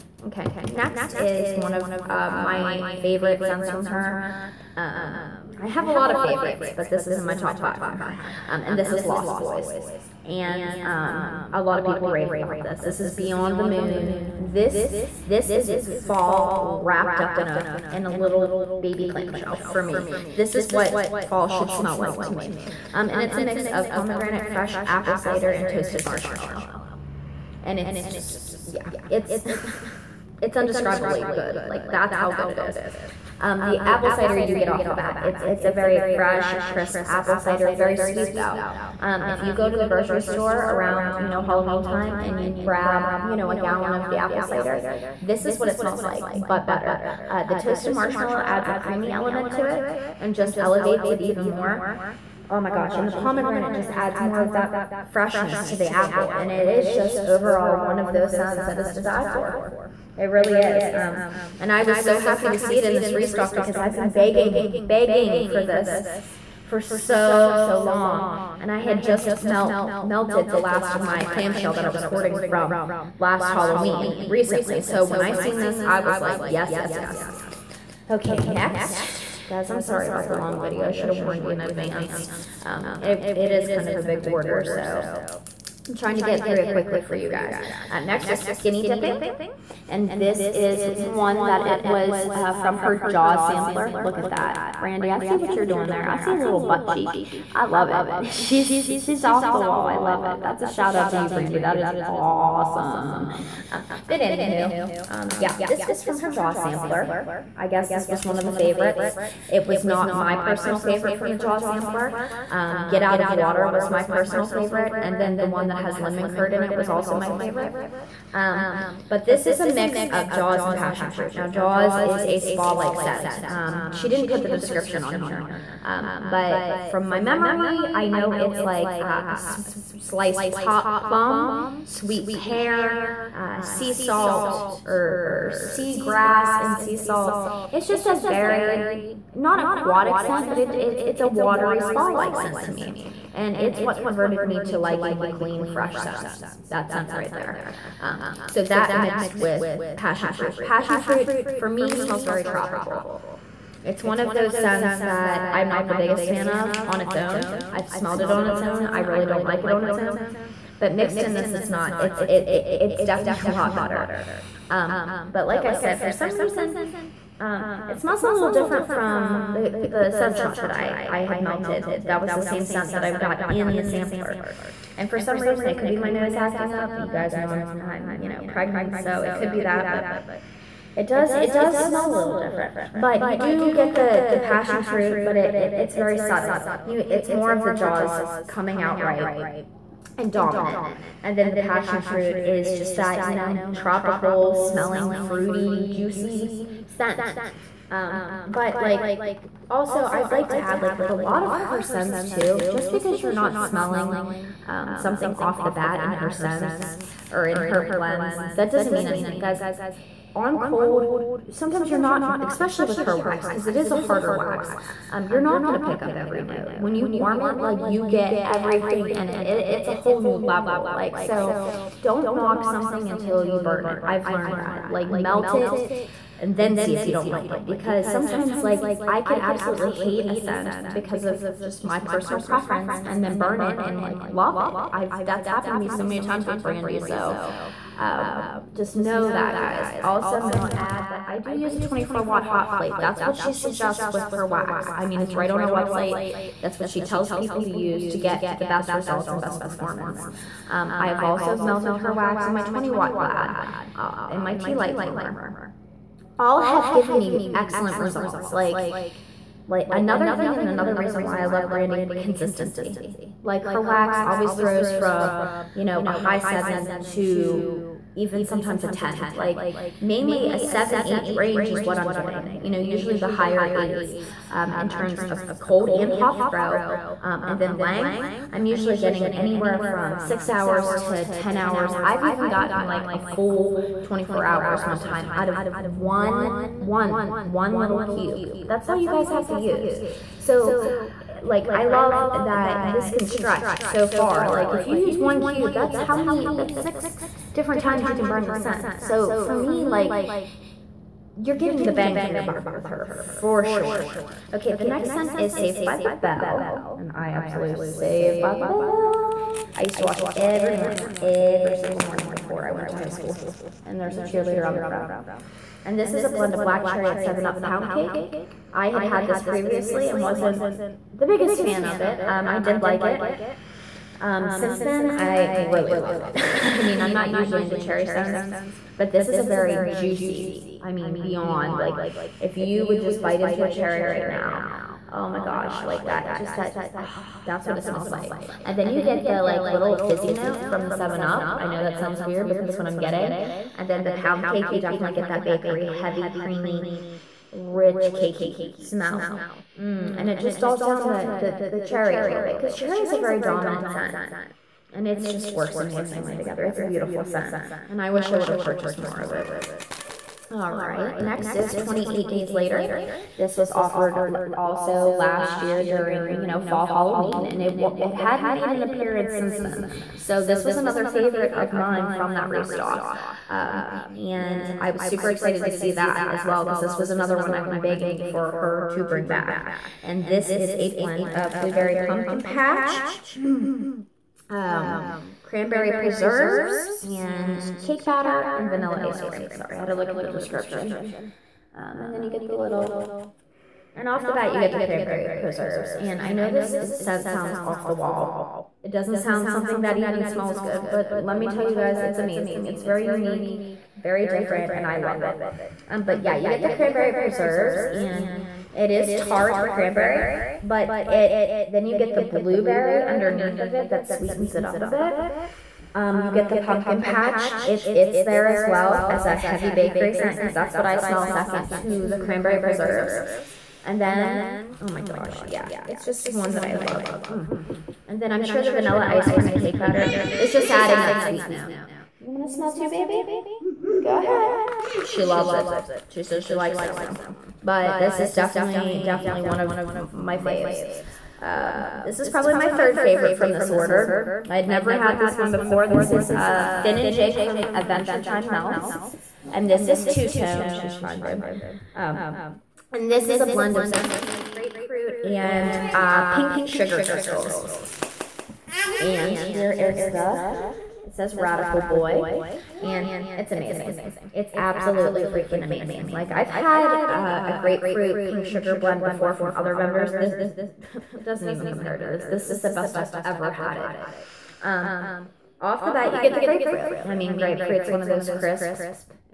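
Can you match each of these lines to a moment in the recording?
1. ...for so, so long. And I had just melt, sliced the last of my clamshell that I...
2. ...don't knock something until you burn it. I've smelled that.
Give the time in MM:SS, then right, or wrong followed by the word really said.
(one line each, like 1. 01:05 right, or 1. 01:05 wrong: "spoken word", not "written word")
1. 01:06 wrong: "melted", not "sliced"
2. 03:42 wrong: "learned", not "smelled".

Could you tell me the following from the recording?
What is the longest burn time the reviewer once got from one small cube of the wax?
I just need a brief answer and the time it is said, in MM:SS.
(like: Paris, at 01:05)
24 hours, at 04:43.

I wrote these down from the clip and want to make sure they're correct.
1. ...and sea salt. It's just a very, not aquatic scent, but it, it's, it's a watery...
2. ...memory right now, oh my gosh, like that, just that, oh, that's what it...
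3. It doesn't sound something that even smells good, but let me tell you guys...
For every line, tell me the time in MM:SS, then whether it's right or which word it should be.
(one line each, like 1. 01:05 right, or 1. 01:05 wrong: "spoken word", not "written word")
1. 02:16 right
2. 05:33 wrong: "cherry", not "memory"
3. 06:38 right.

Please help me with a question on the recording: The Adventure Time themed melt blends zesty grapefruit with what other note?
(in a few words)
Pink sugar crystals.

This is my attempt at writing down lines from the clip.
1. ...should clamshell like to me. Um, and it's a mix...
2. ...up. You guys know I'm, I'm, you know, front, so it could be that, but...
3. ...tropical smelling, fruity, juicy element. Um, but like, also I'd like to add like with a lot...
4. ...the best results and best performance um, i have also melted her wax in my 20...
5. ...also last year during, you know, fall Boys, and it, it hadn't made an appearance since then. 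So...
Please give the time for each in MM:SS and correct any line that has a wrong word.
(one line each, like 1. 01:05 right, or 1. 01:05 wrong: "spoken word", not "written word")
1. 00:21 wrong: "smell", not "clamshell"
2. 02:56 wrong: "pregnant", not "front"
3. 03:13 wrong: "scent", not "element"
4. 04:08 right
5. 06:04 wrong: "Halloween", not "Boys".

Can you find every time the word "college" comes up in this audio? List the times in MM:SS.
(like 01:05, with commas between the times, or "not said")
not said.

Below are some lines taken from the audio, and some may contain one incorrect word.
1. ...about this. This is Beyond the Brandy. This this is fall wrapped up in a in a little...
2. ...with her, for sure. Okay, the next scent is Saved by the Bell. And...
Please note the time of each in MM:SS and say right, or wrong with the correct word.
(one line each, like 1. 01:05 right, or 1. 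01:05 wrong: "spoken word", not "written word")
1. 00:12 wrong: "Moon", not "Brandy"
2. 05:02 right.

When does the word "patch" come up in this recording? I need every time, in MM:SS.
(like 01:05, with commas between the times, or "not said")
06:22, 06:57.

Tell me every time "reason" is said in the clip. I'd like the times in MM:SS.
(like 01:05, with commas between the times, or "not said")
02:46, 02:55, 04:20.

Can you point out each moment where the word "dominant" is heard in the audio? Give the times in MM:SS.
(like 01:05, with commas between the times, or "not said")
03:10, 05:53.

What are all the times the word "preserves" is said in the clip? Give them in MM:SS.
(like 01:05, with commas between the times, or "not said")
06:25, 06:35, 06:47, 07:02.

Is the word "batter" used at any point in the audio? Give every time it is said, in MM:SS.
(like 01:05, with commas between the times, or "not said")
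06:28, 07:09.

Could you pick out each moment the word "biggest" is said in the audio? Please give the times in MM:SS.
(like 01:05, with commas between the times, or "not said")
02:35, 05:21.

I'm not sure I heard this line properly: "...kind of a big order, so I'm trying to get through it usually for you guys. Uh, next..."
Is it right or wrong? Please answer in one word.
wrong.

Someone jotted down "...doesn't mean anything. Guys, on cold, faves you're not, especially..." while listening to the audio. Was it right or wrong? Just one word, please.
wrong.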